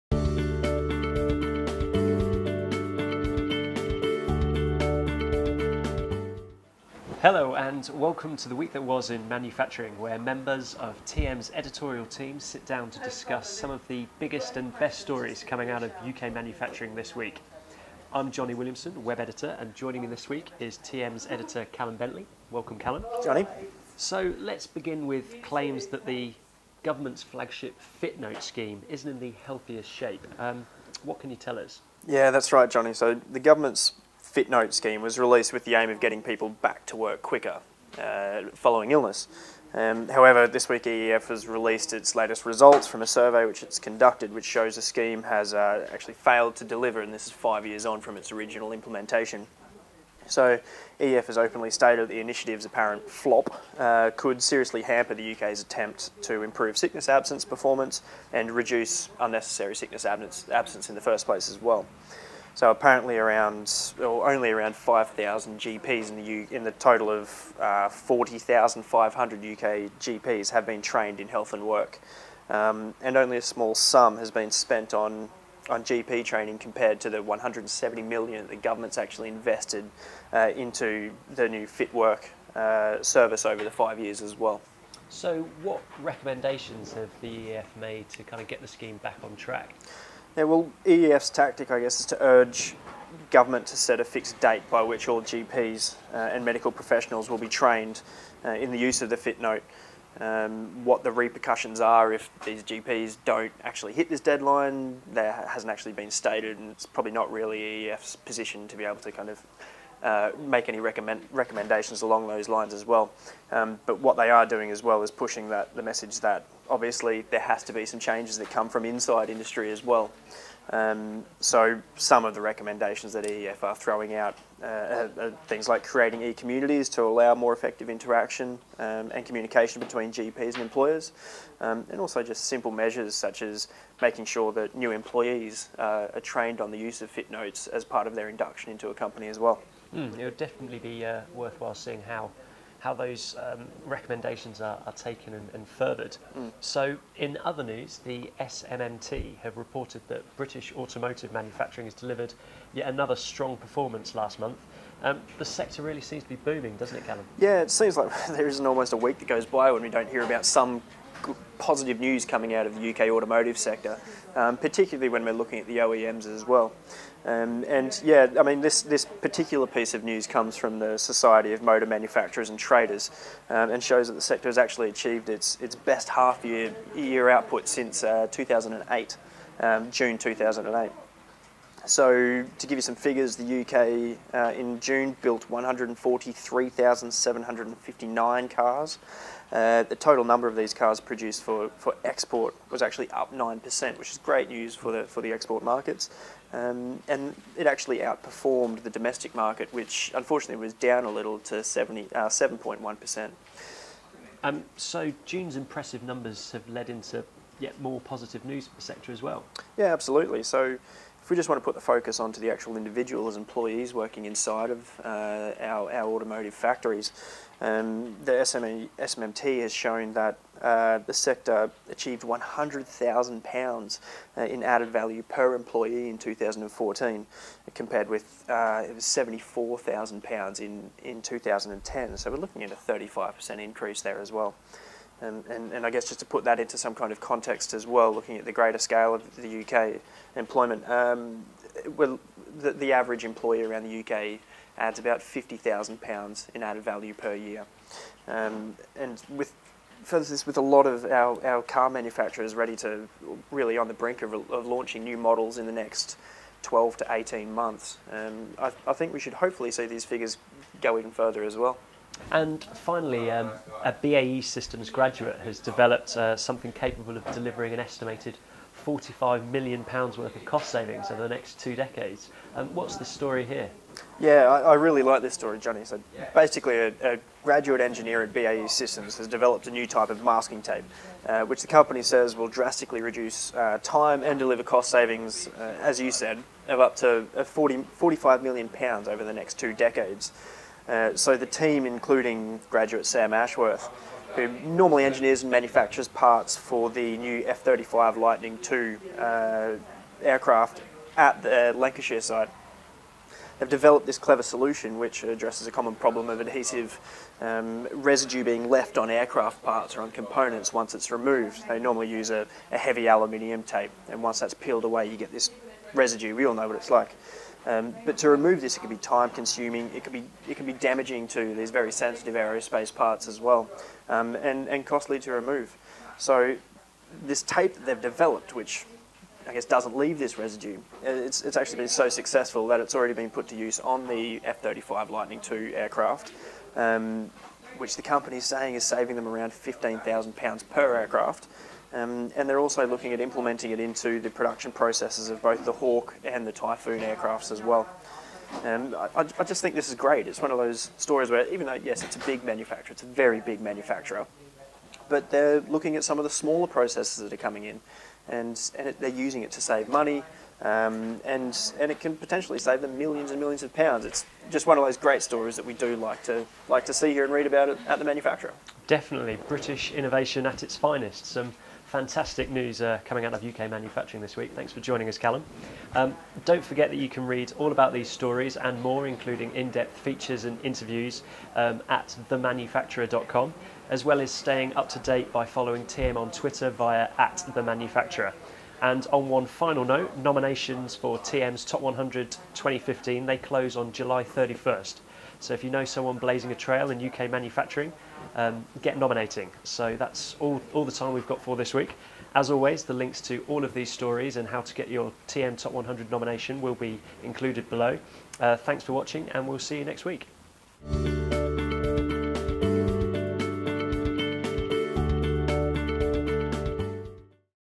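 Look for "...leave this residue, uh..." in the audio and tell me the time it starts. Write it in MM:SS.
05:29.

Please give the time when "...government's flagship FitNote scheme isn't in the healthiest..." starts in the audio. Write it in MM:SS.
00:26.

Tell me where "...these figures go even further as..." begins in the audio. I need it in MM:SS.
04:19.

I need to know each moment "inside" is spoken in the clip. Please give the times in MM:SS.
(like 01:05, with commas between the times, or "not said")
01:58, 03:34.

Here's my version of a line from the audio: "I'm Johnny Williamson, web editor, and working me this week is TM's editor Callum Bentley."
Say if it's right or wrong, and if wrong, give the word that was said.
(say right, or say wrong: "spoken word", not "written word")
wrong: "joining", not "working".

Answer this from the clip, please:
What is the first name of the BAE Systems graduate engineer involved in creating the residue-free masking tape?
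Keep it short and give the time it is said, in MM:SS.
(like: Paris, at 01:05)
Sam, at 04:53.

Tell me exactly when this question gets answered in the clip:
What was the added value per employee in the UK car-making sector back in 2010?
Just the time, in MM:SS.
03:48.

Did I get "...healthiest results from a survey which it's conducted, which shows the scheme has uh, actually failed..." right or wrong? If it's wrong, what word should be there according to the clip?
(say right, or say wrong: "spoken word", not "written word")
wrong: "latest", not "healthiest".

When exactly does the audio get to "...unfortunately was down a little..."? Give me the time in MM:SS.
03:20.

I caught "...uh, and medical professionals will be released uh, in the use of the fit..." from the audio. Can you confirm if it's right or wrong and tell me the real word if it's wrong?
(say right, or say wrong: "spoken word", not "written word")
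wrong: "trained", not "released".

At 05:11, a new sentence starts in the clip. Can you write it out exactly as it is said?
They normally use a, a heavy aluminium tape, and once that's peeled away, you get this residue.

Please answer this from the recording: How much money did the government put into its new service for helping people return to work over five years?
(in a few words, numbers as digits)
170 million.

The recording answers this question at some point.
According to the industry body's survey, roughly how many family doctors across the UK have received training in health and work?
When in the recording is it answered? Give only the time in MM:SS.
01:04.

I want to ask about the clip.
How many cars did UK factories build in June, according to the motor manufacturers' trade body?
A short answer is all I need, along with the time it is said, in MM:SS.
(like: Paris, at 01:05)
143,759, at 03:05.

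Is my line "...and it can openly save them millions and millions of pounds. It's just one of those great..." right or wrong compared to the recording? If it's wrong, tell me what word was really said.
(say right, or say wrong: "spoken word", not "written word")
wrong: "potentially", not "openly".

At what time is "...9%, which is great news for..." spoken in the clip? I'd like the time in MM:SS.
03:13.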